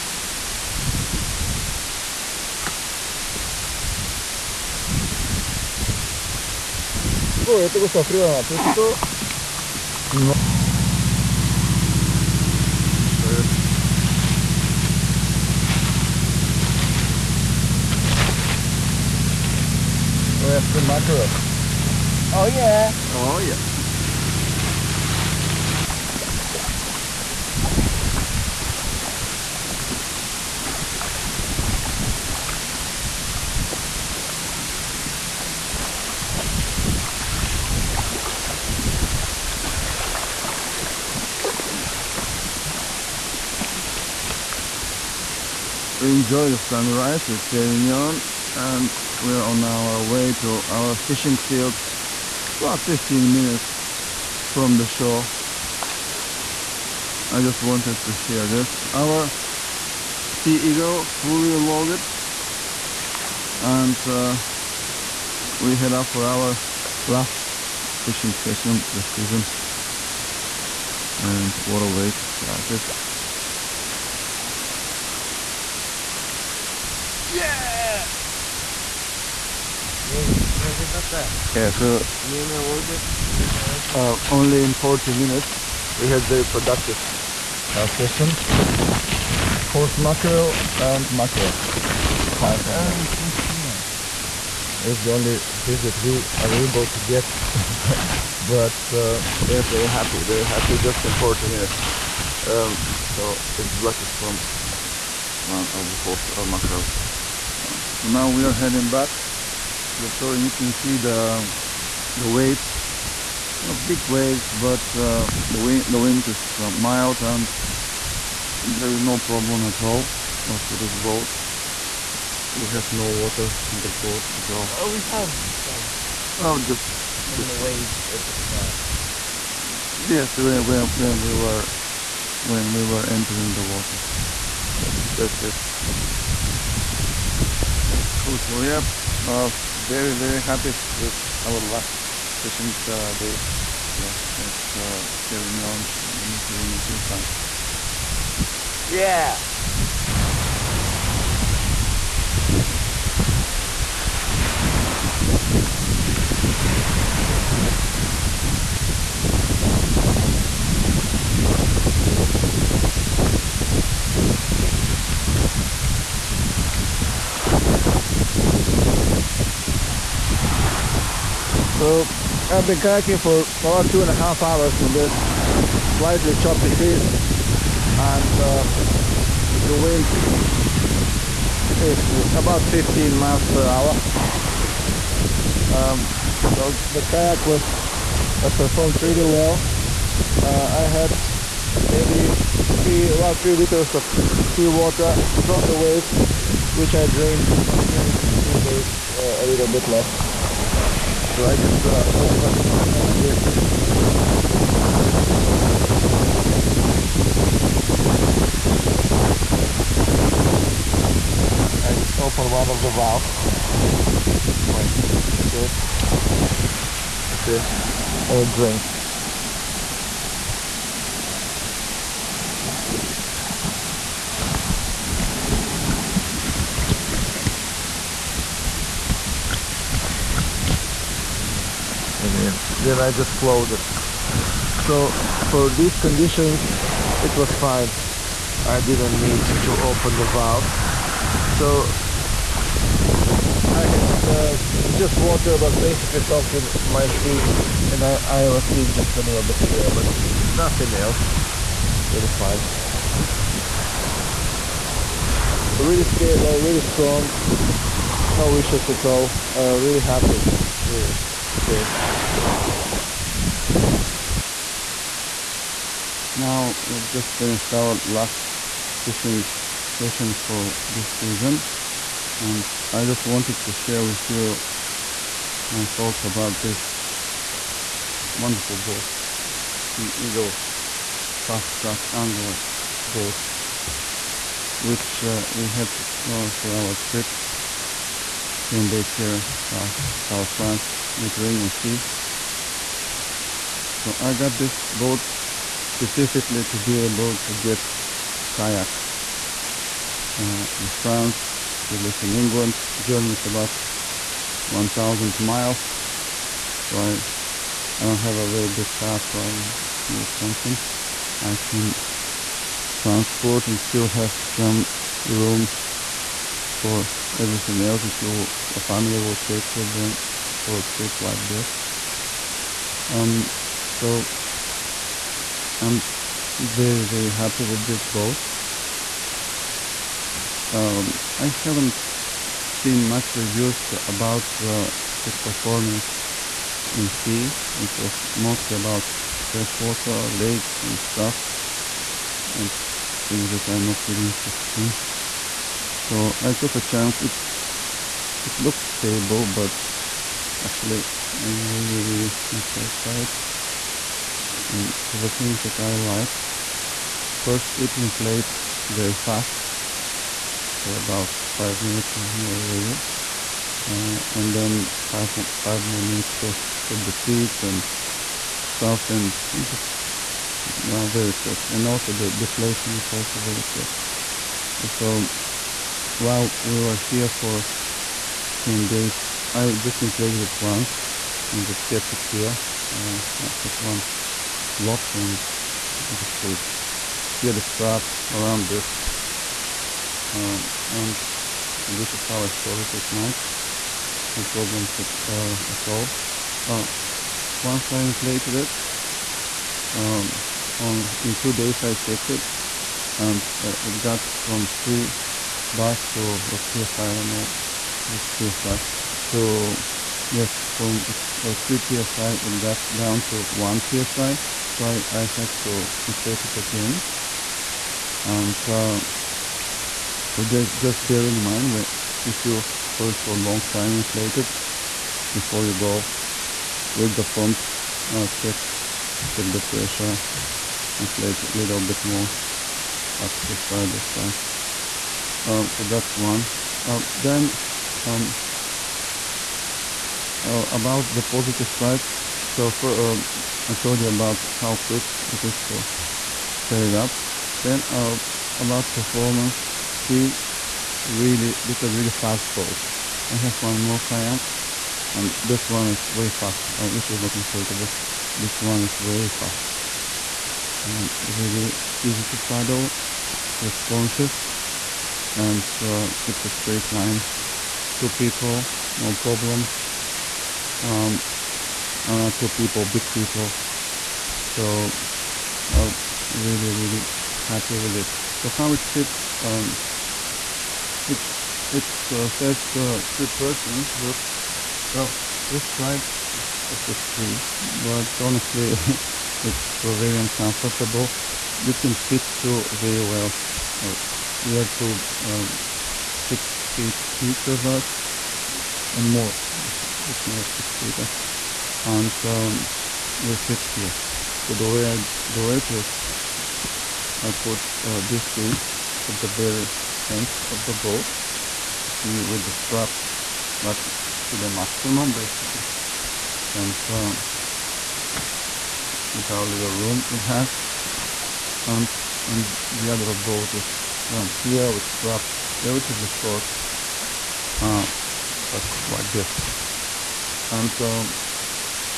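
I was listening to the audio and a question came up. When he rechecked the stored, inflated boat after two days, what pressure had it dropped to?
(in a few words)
1 psi.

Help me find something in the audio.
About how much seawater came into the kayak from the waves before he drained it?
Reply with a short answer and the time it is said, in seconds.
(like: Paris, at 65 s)
3 liters, at 193 s.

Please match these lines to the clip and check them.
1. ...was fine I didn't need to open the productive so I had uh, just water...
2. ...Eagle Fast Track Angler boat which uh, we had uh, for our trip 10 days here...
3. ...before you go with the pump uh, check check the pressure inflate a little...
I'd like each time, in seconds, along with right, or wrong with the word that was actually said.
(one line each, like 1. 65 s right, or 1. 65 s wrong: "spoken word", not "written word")
1. 237 s wrong: "valve", not "productive"
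2. 280 s right
3. 425 s right.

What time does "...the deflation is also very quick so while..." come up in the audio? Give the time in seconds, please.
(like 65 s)
372 s.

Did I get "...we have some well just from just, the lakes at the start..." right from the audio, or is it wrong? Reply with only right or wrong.
wrong.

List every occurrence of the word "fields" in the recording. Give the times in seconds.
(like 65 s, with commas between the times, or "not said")
51 s.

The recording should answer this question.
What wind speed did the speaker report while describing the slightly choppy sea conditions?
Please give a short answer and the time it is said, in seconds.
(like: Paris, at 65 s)
15 miles per hour, at 182 s.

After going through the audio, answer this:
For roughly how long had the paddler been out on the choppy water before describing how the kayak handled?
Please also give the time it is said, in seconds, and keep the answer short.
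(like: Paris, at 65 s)
2.5 hours, at 173 s.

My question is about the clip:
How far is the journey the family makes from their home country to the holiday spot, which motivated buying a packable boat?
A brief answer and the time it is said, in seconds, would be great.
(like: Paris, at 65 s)
1,000 miles, at 304 s.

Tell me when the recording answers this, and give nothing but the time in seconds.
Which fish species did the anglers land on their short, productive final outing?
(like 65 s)
89 s.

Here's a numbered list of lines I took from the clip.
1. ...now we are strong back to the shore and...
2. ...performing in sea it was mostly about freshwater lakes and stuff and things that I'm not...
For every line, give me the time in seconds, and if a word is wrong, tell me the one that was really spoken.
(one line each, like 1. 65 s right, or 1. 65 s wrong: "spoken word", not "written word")
1. 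108 s wrong: "heading", not "strong"
2. 335 s right.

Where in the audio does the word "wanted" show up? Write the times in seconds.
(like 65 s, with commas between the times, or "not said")
57 s, 273 s.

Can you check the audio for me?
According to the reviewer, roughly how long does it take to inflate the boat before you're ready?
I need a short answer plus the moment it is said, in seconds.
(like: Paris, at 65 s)
5 minutes, at 361 s.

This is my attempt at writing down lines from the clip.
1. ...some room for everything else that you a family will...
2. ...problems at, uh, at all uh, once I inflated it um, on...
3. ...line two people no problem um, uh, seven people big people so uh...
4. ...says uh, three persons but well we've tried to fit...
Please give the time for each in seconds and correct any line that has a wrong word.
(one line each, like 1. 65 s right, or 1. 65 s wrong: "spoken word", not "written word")
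1. 314 s right
2. 394 s right
3. 466 s wrong: "two", not "seven"
4. 482 s right.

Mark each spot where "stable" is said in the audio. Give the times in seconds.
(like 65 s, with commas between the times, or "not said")
256 s, 348 s.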